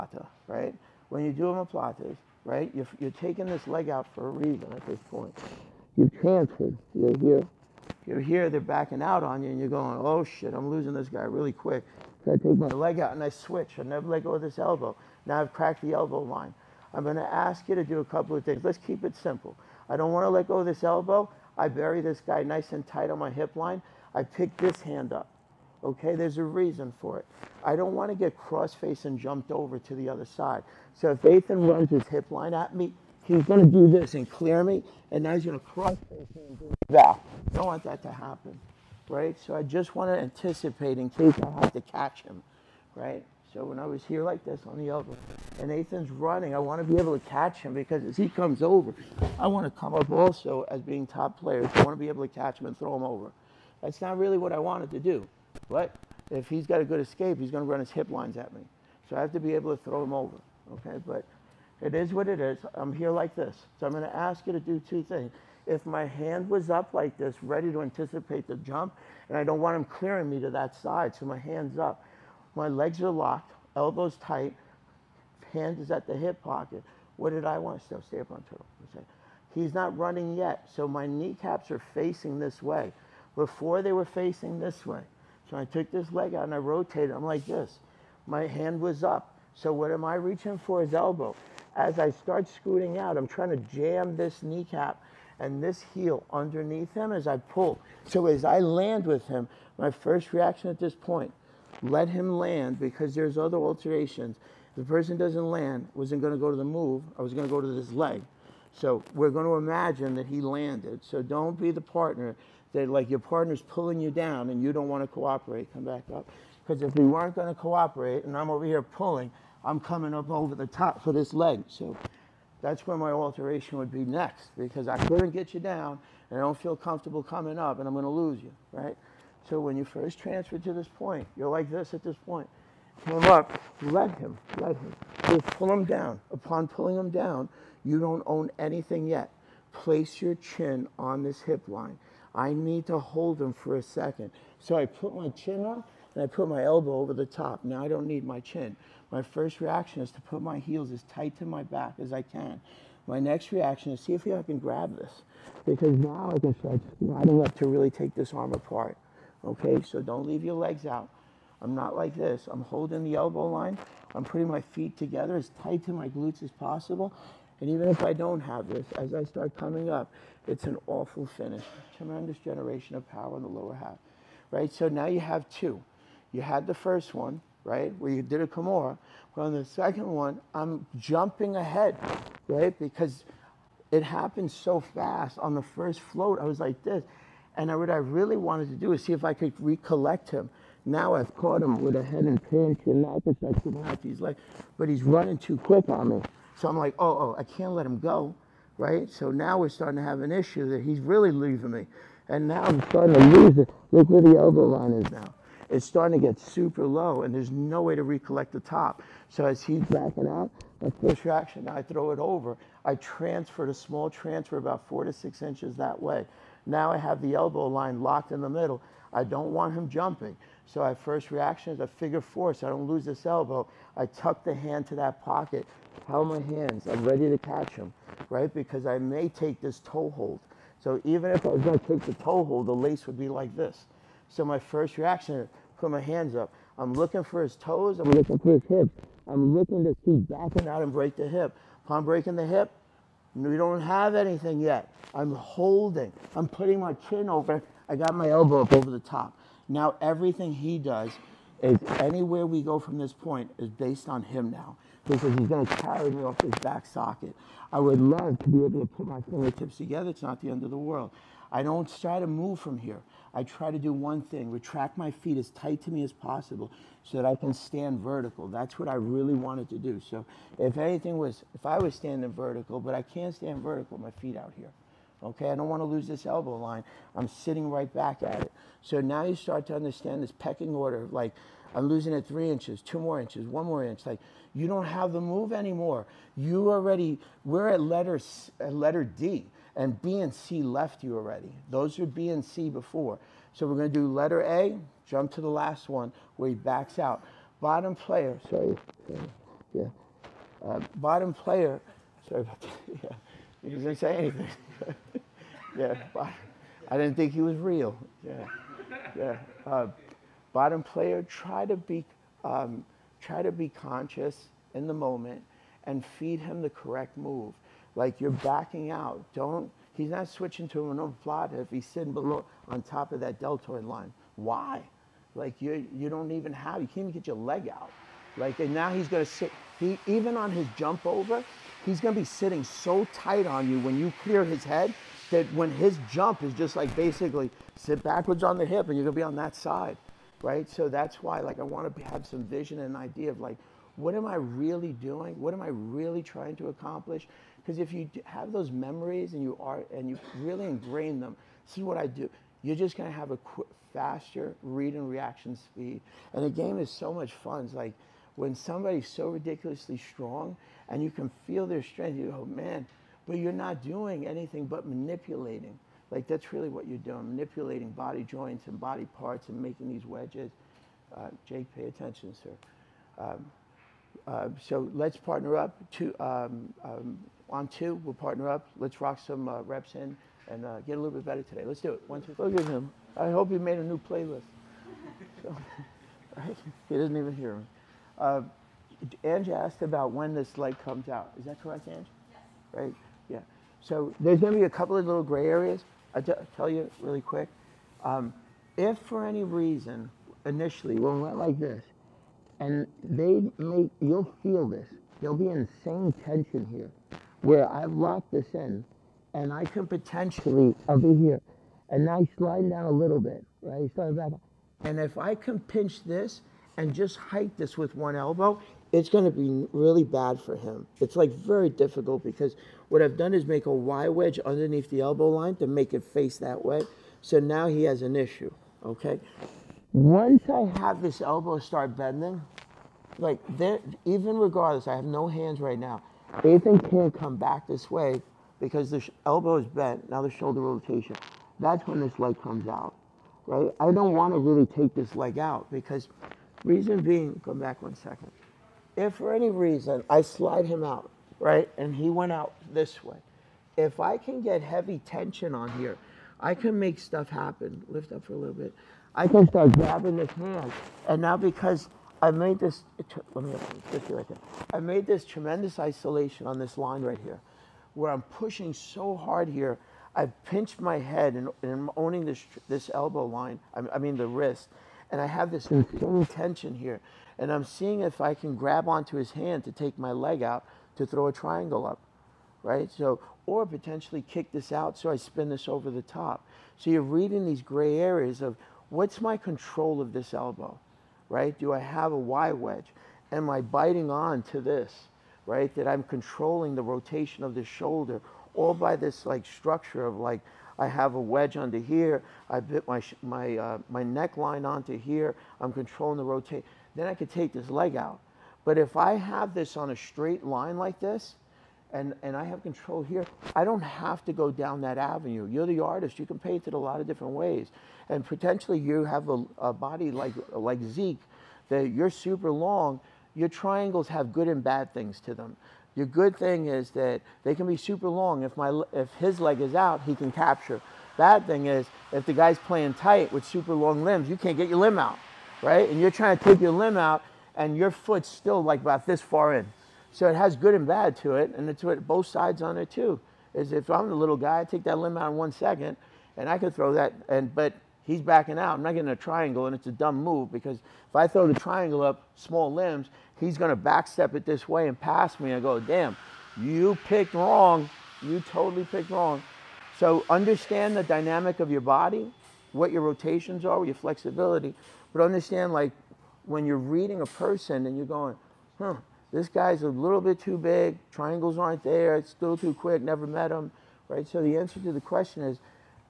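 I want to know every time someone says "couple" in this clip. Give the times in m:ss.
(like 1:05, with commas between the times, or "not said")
0:18, 6:34.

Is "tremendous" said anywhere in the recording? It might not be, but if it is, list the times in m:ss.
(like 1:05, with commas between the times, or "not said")
2:51, 7:45.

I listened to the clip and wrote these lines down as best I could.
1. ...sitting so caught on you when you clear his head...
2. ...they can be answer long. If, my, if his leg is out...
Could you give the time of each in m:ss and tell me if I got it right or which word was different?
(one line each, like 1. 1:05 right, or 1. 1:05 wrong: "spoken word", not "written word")
1. 5:32 wrong: "tight", not "caught"
2. 8:47 wrong: "super", not "answer".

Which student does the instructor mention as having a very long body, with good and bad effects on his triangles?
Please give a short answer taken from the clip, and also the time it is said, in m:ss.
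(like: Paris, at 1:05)
Zeke, at 8:40.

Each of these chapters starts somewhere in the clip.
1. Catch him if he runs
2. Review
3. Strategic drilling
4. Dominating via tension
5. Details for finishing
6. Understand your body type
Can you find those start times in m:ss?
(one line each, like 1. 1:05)
1. 0:23
2. 2:58
3. 5:13
4. 6:36
5. 1:17
6. 8:39.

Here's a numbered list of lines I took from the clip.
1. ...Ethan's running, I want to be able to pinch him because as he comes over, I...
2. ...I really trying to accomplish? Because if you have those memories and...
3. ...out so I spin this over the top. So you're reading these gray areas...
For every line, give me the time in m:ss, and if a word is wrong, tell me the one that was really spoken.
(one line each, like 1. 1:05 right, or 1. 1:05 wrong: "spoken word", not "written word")
1. 0:45 wrong: "catch", not "pinch"
2. 5:45 right
3. 8:04 right.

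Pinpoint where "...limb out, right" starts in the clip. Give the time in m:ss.
8:54.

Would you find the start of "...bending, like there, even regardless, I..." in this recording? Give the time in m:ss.
7:11.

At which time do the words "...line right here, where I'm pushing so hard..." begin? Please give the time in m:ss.
7:46.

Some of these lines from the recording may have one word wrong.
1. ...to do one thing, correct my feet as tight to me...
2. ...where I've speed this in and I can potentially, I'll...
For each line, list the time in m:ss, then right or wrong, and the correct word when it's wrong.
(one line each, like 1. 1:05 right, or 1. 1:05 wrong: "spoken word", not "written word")
1. 4:23 wrong: "retract", not "correct"
2. 6:47 wrong: "locked", not "speed".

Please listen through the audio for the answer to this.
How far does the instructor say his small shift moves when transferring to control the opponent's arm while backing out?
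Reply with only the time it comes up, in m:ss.
3:34.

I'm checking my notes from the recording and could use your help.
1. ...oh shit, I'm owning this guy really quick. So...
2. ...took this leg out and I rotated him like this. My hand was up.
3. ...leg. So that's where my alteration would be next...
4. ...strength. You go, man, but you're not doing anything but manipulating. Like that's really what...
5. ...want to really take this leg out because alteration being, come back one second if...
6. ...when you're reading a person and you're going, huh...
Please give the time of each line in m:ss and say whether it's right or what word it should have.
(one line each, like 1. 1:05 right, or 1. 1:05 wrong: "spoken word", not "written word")
1. 0:10 wrong: "losing", not "owning"
2. 1:25 right
3. 2:01 right
4. 6:01 right
5. 7:24 wrong: "reason", not "alteration"
6. 9:26 right.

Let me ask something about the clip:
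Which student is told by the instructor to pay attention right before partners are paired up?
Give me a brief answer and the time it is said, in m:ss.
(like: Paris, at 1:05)
Jake, at 6:11.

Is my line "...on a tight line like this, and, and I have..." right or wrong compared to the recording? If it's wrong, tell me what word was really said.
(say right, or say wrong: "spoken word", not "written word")
wrong: "straight", not "tight".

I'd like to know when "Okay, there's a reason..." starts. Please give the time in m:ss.
0:25.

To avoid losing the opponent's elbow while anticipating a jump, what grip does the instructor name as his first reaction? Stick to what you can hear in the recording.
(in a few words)
figure four.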